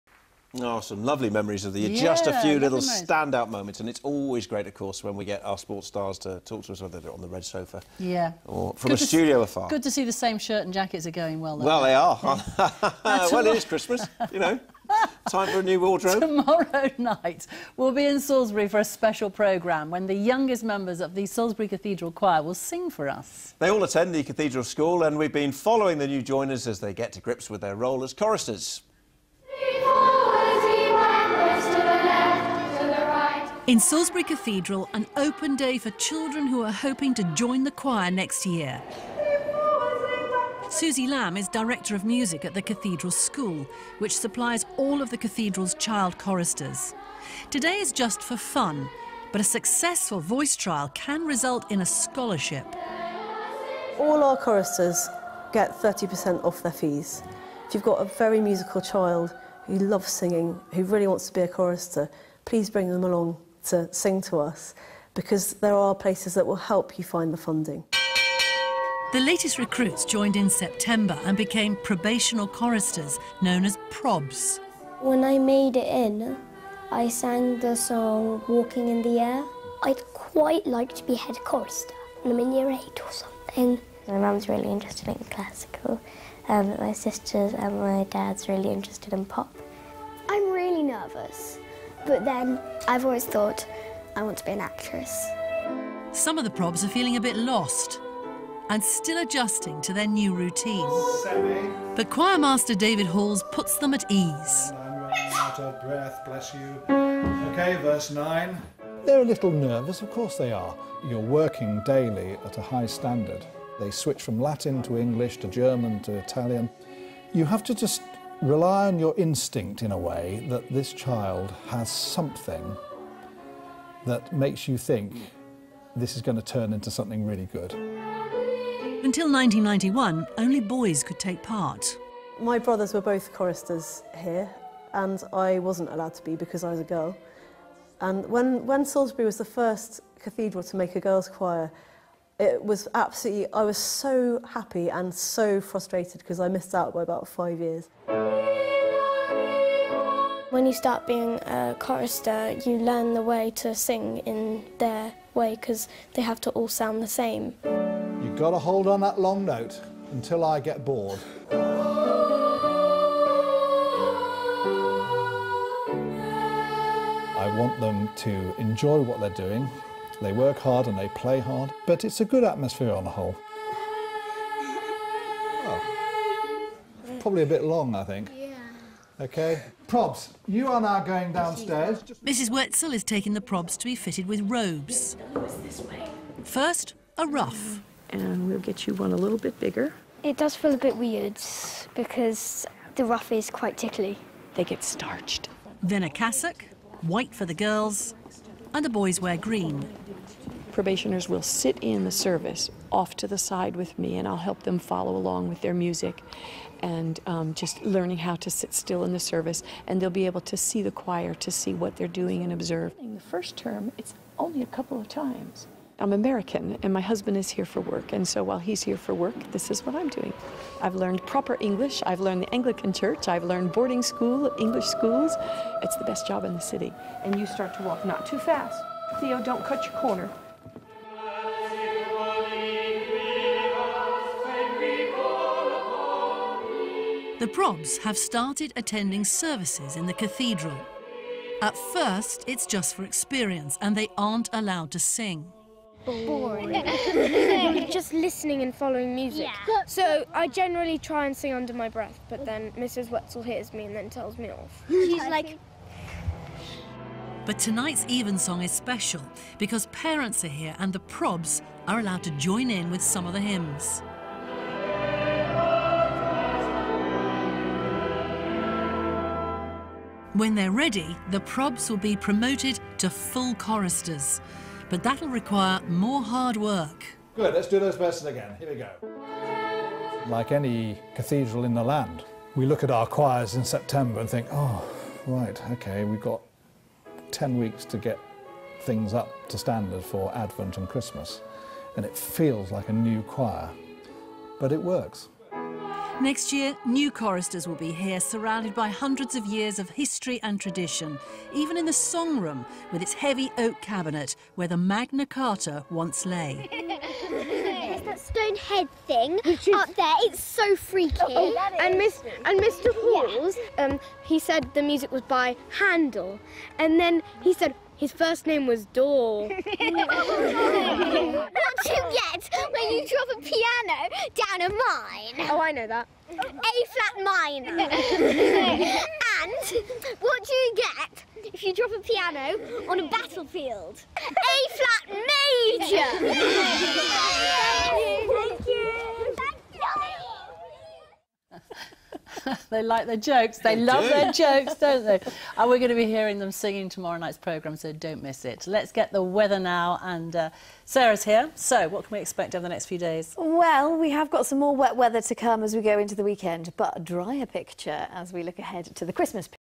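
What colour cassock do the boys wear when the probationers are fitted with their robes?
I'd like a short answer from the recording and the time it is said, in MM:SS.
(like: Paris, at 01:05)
Green, at 03:19.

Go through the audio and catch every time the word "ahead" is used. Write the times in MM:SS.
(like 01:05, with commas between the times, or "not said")
05:58.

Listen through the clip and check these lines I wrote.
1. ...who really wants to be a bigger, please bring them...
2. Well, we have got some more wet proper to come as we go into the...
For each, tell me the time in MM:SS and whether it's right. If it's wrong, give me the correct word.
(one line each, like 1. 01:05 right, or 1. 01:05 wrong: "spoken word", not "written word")
1. 01:00 wrong: "chorister", not "bigger"
2. 05:53 wrong: "weather", not "proper".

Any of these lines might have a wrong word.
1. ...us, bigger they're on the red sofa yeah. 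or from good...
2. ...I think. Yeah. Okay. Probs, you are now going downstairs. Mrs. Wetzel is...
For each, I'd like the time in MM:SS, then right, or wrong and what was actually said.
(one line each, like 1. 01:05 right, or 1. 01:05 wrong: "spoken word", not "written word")
1. 00:06 wrong: "whether", not "bigger"
2. 02:57 right.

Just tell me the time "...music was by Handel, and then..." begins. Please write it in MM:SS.
05:14.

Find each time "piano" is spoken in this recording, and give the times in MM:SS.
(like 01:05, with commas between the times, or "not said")
05:23, 05:31.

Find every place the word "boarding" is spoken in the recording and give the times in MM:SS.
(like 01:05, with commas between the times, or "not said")
03:43.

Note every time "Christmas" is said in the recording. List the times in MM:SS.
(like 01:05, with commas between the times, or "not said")
00:13, 04:50, 05:59.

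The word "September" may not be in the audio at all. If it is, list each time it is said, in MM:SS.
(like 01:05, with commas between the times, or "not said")
01:10, 04:43.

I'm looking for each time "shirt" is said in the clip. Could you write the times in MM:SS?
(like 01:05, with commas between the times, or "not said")
00:10.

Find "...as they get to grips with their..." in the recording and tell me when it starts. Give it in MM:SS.
00:26.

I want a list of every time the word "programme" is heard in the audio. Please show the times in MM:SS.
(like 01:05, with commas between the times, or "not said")
00:19, 05:47.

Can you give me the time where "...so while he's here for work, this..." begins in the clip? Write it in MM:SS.
03:38.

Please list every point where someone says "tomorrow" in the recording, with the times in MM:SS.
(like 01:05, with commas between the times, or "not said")
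00:16, 05:46.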